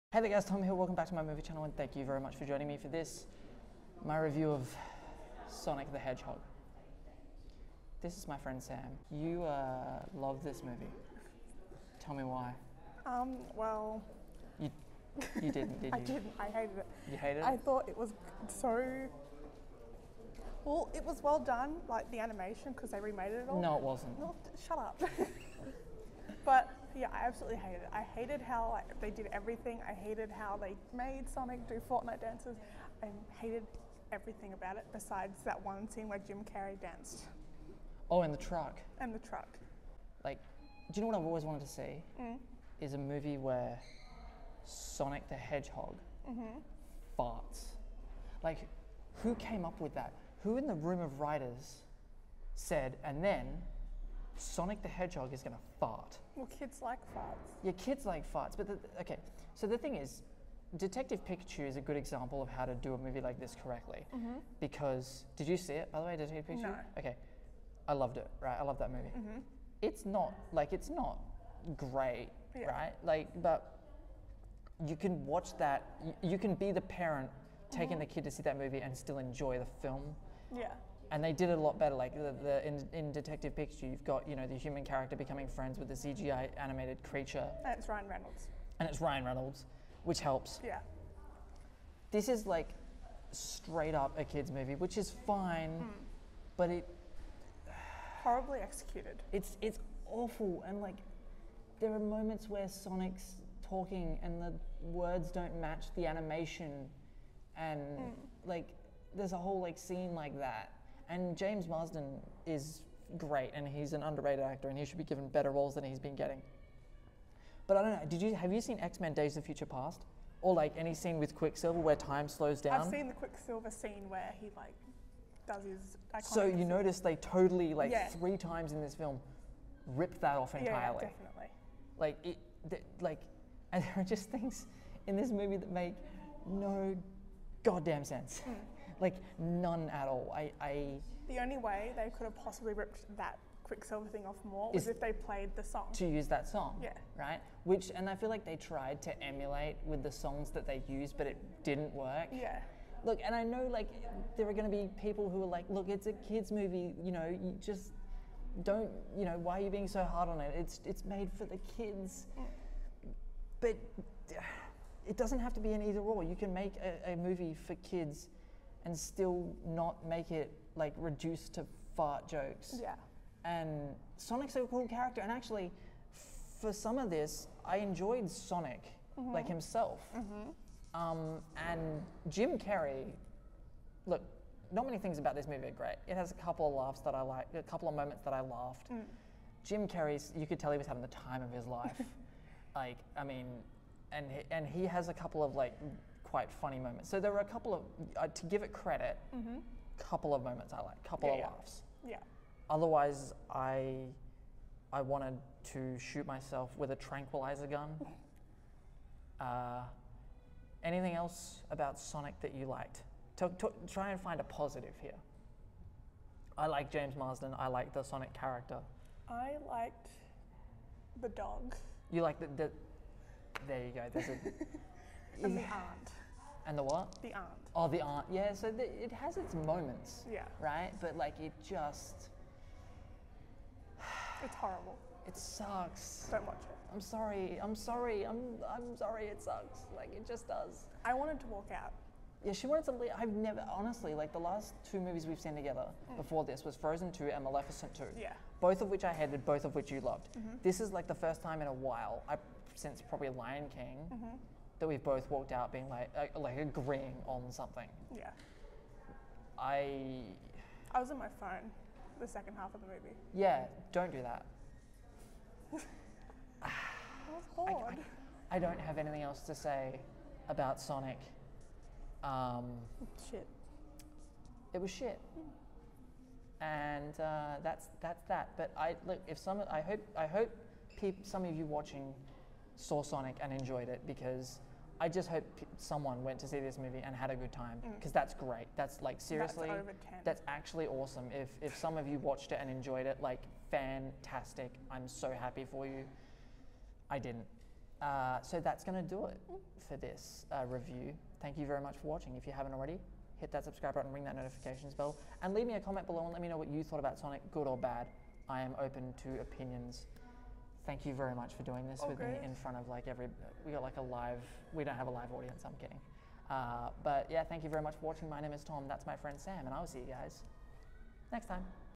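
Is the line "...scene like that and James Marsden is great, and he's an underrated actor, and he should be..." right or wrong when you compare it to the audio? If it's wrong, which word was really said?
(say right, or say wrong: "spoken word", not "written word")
right.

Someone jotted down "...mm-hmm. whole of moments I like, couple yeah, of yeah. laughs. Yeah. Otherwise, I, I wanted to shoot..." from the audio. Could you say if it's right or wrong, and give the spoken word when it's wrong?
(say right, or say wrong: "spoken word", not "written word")
wrong: "couple", not "whole".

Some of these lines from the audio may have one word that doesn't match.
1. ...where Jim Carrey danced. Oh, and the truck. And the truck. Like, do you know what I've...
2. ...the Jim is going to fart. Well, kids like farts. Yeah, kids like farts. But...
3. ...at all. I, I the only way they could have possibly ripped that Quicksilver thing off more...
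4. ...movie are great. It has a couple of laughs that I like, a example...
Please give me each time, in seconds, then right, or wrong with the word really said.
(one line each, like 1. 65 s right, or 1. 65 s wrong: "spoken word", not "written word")
1. 36 s right
2. 54 s wrong: "Hedgehog", not "Jim"
3. 139 s right
4. 185 s wrong: "couple", not "example".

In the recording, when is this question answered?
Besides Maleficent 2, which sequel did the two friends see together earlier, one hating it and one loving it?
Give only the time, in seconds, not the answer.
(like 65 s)
246 s.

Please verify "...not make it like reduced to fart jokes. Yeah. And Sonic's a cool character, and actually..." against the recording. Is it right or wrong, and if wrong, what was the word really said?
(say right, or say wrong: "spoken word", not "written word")
right.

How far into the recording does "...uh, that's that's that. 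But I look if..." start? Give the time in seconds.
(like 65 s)
277 s.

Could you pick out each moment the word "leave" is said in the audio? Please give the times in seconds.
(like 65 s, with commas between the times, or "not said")
242 s, 305 s.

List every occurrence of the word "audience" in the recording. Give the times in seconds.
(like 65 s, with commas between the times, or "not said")
315 s.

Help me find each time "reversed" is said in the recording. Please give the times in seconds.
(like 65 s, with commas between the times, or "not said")
not said.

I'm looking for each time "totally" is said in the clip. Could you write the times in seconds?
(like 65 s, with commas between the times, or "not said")
127 s.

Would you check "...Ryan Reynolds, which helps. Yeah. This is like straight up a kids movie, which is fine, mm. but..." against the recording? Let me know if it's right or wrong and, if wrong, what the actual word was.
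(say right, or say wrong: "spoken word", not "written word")
right.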